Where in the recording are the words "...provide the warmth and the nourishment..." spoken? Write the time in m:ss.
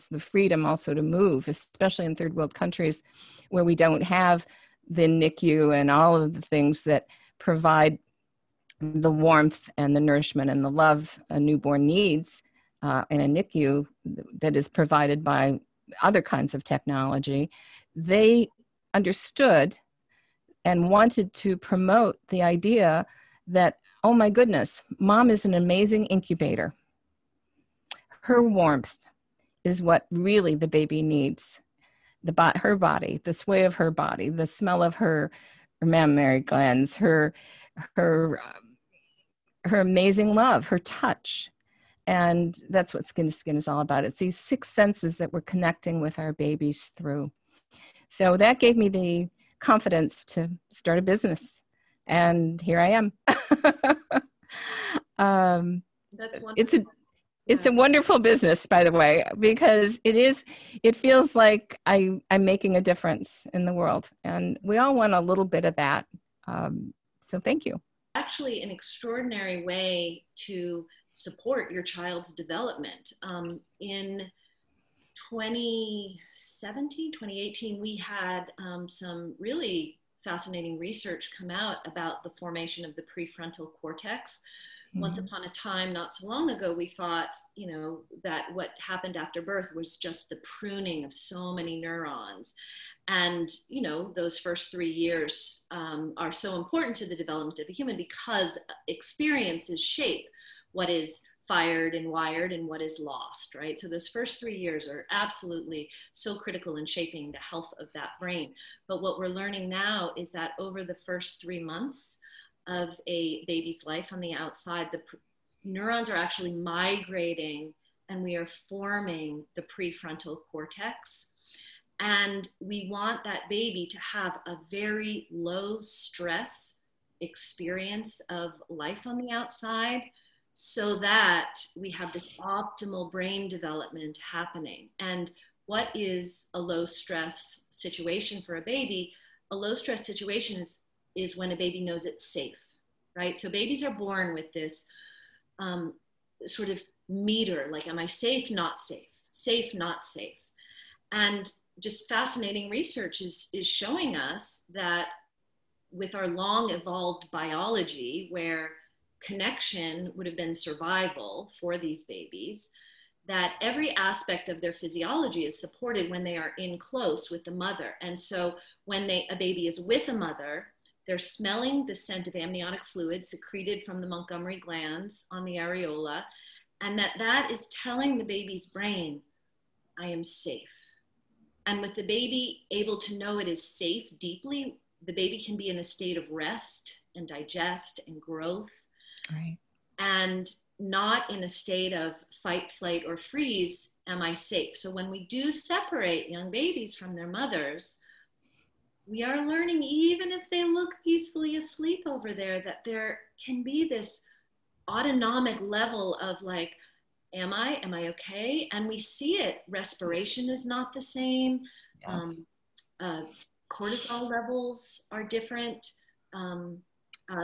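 0:07.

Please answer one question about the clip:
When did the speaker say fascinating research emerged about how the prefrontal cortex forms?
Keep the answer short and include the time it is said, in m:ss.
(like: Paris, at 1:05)
2017, 2018, at 1:15.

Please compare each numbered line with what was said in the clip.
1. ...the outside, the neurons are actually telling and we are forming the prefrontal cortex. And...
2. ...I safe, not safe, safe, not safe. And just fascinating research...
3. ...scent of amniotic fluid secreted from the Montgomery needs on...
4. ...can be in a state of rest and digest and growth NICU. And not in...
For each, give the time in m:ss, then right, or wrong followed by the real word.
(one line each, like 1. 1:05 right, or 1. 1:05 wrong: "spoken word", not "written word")
1. 1:54 wrong: "migrating", not "telling"
2. 2:27 right
3. 2:51 wrong: "glands", not "needs"
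4. 3:05 wrong: "Right", not "NICU".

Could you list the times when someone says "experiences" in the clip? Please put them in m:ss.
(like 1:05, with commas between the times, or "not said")
1:38, 2:07.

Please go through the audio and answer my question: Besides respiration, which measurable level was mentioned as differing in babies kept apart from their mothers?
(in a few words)
cortisol levels.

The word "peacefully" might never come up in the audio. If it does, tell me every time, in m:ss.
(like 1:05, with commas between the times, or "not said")
3:21.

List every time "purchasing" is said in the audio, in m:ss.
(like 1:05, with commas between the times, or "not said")
not said.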